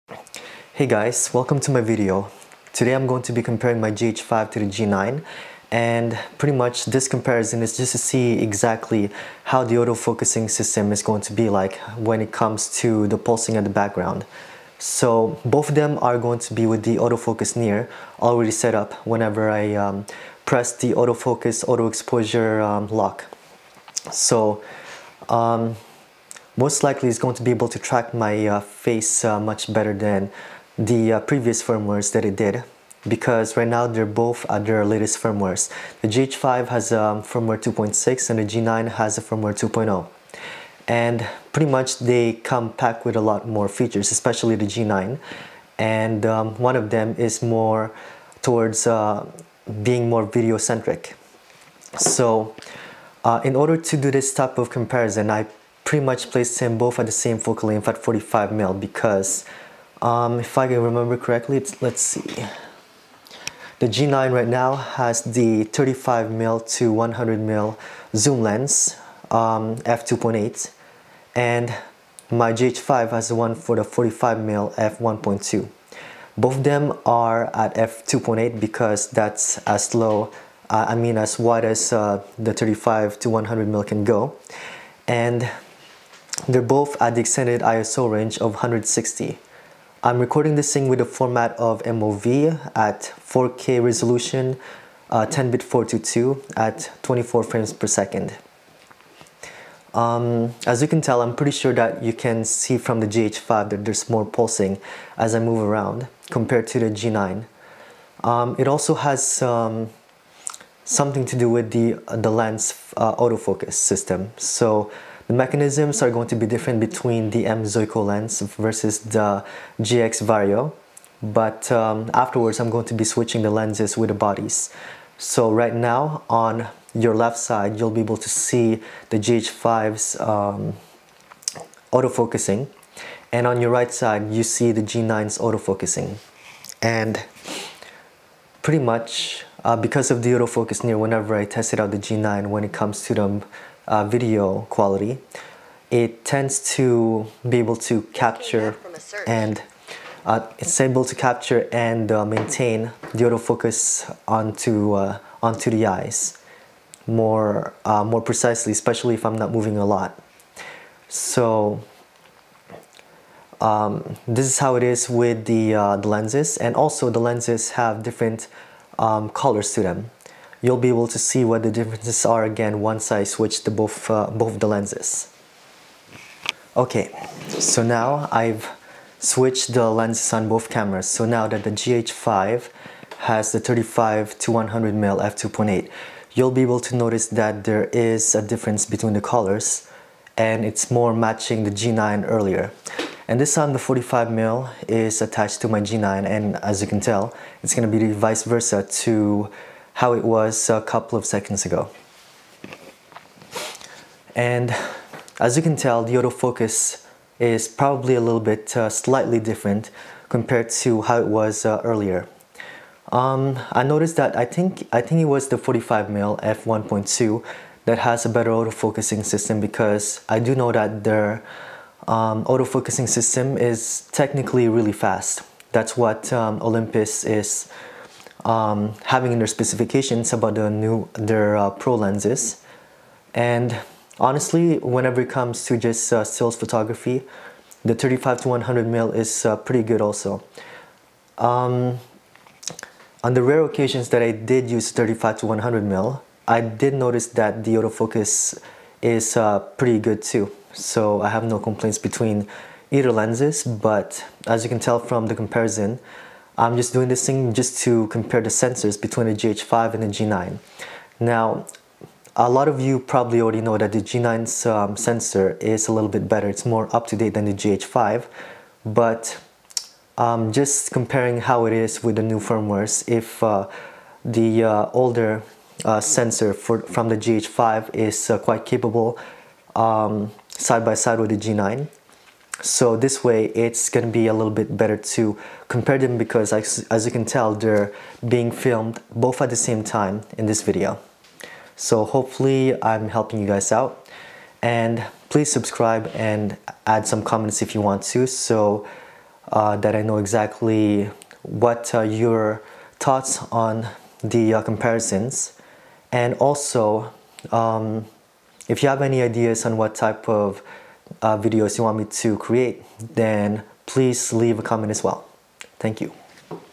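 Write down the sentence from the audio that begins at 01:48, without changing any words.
Um, it also has um, something to do with the, the lens uh, autofocus system.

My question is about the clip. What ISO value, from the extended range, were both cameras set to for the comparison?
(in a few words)
160.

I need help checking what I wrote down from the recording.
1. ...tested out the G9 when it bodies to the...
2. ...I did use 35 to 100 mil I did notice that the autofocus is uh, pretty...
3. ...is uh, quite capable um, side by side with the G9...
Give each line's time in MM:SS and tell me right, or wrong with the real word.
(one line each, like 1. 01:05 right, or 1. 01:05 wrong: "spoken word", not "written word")
1. 02:21 wrong: "comes", not "bodies"
2. 04:04 right
3. 04:37 right.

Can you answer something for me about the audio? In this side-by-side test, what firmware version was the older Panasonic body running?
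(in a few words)
2.6.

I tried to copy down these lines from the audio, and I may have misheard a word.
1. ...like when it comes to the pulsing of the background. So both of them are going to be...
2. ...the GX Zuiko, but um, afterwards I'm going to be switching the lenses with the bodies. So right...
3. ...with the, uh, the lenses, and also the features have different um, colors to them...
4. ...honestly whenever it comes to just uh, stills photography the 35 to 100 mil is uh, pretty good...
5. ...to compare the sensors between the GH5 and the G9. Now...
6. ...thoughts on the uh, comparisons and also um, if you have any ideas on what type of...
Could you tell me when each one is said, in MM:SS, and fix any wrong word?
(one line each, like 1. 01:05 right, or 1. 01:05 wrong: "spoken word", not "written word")
1. 00:11 right
2. 01:58 wrong: "Vario", not "Zuiko"
3. 02:45 wrong: "lenses", not "features"
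4. 03:54 right
5. 04:17 right
6. 05:02 right.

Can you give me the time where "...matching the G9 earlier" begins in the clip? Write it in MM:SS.
03:11.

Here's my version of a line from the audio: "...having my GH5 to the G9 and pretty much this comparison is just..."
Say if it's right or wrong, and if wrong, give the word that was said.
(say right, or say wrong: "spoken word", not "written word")
wrong: "comparing", not "having".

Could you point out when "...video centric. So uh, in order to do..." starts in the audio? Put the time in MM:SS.
00:50.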